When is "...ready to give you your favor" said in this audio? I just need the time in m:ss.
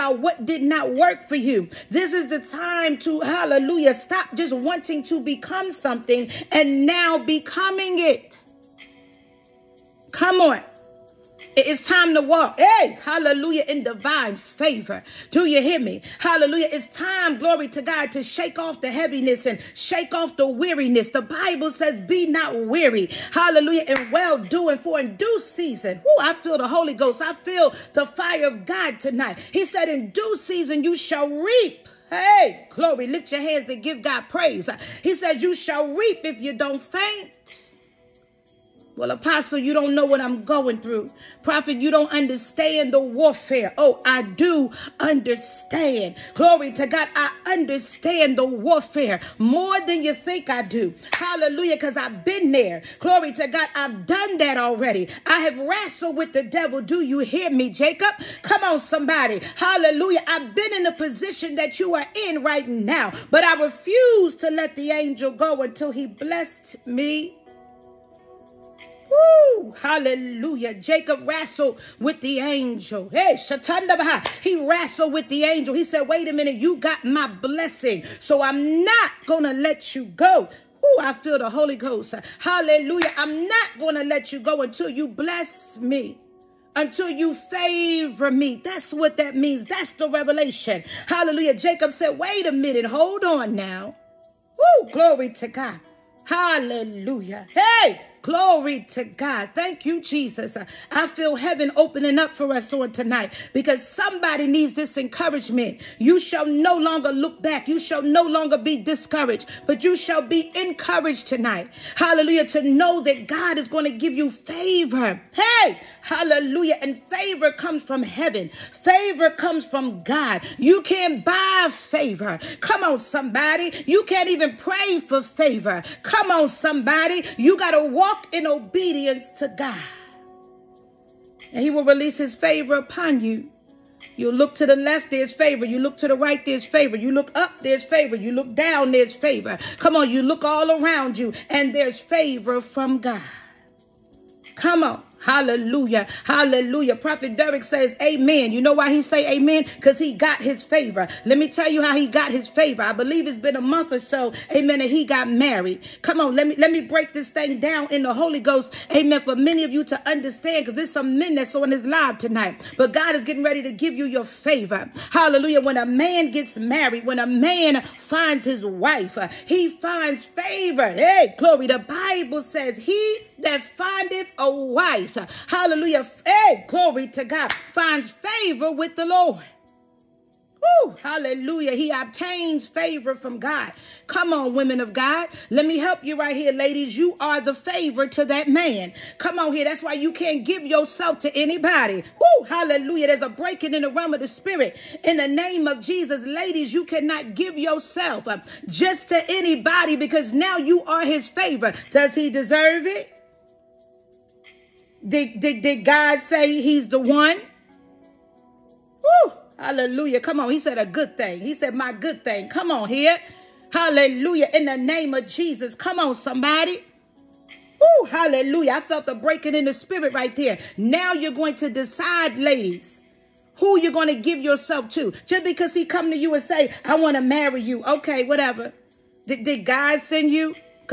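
2:43.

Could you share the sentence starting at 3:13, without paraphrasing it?
There's a breaking in the realm of the spirit.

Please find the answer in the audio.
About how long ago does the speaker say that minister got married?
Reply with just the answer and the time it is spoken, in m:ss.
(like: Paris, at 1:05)
a month or so, at 2:33.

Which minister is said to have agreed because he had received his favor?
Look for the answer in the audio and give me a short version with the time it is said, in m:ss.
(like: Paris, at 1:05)
Prophet Derek, at 2:26.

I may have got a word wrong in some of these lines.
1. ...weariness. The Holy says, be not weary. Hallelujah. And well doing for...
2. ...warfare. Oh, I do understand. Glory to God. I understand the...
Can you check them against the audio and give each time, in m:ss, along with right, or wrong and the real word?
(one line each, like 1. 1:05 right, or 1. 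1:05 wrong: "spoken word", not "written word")
1. 0:20 wrong: "Bible", not "Holy"
2. 0:42 right.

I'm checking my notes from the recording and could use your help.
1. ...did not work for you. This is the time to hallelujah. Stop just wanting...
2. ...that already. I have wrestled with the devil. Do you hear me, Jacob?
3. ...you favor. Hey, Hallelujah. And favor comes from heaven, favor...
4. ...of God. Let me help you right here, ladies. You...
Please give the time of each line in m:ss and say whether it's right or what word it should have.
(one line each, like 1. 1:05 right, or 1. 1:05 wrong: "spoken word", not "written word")
1. 0:00 right
2. 0:54 right
3. 1:54 right
4. 3:04 right.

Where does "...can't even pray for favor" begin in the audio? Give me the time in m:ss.
2:04.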